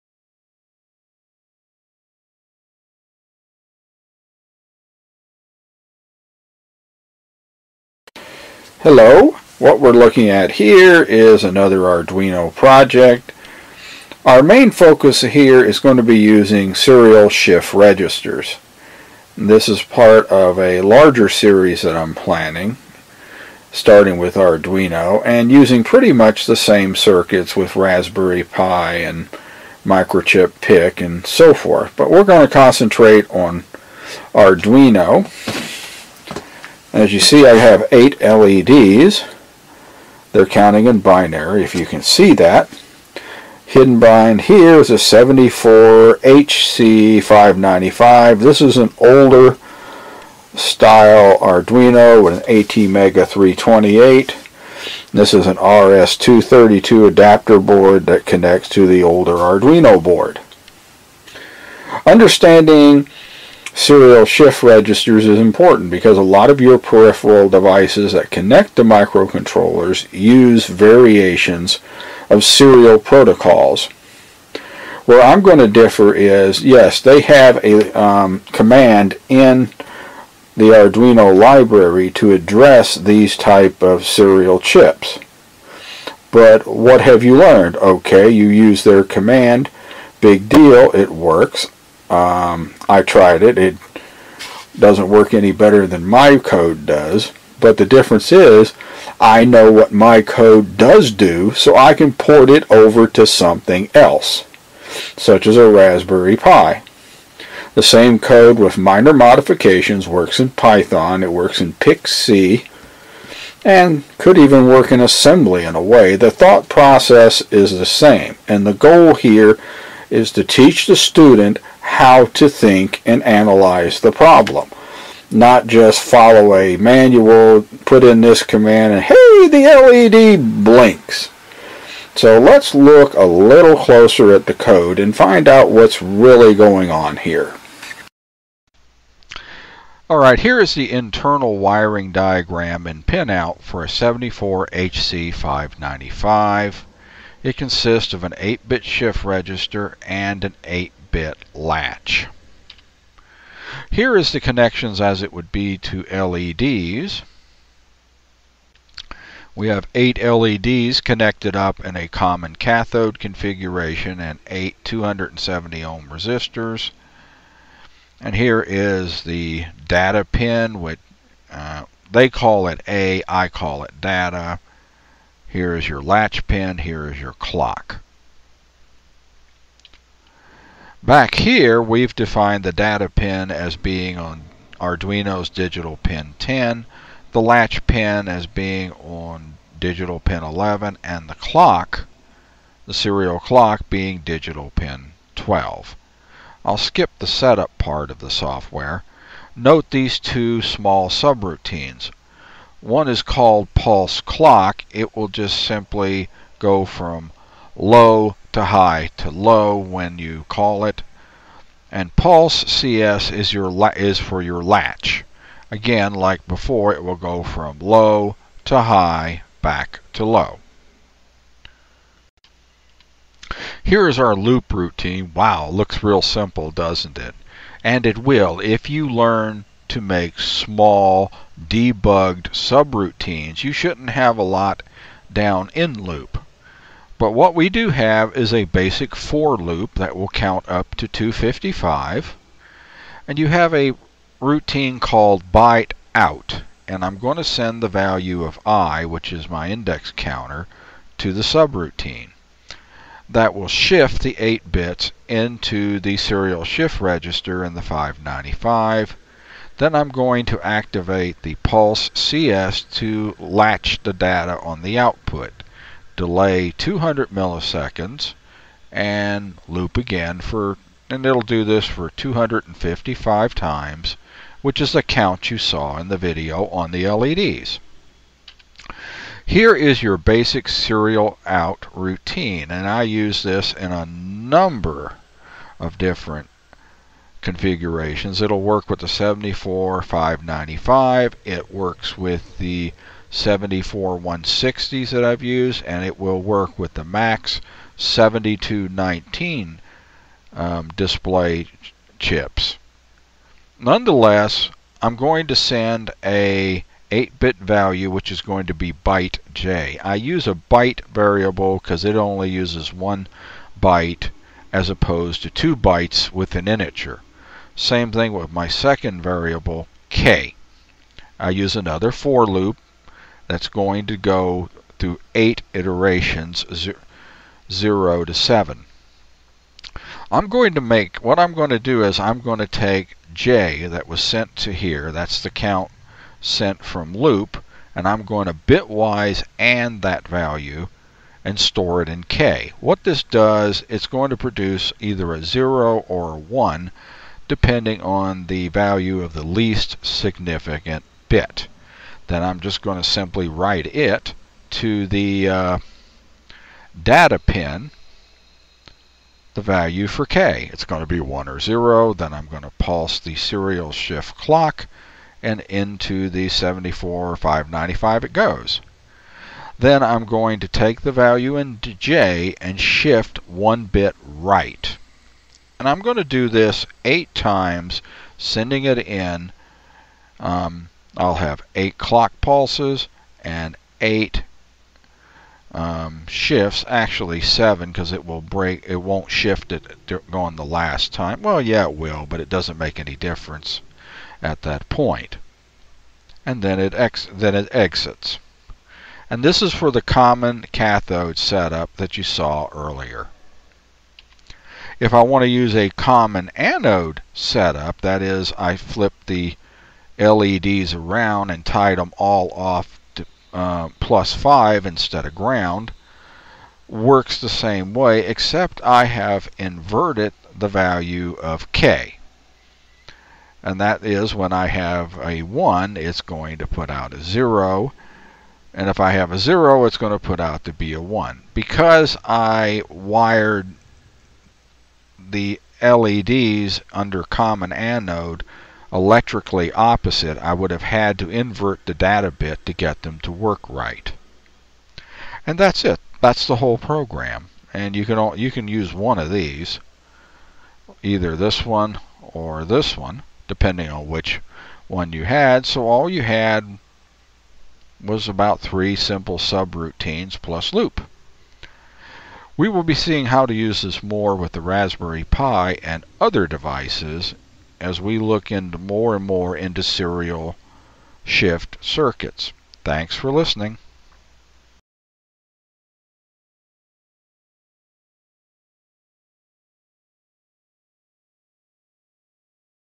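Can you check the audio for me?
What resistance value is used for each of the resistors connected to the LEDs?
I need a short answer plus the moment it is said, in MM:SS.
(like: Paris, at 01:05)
270 ohm, at 02:44.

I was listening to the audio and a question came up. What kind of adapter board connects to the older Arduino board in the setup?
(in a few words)
RS232 adapter board.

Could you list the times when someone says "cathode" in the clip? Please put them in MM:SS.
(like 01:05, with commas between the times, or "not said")
02:42, 06:40.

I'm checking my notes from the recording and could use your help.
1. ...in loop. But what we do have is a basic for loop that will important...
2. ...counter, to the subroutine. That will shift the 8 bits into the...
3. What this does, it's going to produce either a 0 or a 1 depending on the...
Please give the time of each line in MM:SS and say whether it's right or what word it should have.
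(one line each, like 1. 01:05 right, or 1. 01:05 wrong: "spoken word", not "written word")
1. 03:55 wrong: "count", not "important"
2. 04:10 right
3. 05:42 right.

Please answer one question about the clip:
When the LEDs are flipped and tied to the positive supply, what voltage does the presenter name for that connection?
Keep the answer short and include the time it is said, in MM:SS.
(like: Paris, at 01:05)
plus 5, at 06:53.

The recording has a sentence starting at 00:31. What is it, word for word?
But we're going to concentrate on Arduino as you see, I have eight LEDs.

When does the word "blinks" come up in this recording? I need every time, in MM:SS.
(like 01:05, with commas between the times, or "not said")
02:10.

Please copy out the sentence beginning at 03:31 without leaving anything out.
And pulse CS is your is for your latch.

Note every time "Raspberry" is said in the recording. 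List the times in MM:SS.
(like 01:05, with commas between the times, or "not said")
00:27, 01:45, 07:44.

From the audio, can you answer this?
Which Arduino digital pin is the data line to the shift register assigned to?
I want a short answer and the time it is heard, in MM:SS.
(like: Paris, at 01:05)
10, at 03:05.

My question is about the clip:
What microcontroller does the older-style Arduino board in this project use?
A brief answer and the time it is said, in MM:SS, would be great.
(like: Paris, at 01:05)
ATmega 328, at 00:52.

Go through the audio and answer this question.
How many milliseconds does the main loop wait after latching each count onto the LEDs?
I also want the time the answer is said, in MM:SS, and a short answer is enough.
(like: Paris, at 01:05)
200, at 04:26.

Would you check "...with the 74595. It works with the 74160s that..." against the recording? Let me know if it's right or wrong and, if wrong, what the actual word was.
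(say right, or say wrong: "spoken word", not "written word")
right.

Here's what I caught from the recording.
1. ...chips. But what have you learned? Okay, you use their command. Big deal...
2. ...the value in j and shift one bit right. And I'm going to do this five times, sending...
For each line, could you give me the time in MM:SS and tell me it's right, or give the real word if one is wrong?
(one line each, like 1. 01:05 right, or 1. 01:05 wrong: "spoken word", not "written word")
1. 01:24 right
2. 06:11 wrong: "eight", not "five".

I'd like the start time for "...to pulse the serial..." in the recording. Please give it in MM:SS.
06:02.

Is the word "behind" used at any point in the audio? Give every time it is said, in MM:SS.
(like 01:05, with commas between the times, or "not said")
00:44.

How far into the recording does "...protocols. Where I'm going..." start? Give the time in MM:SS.
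01:12.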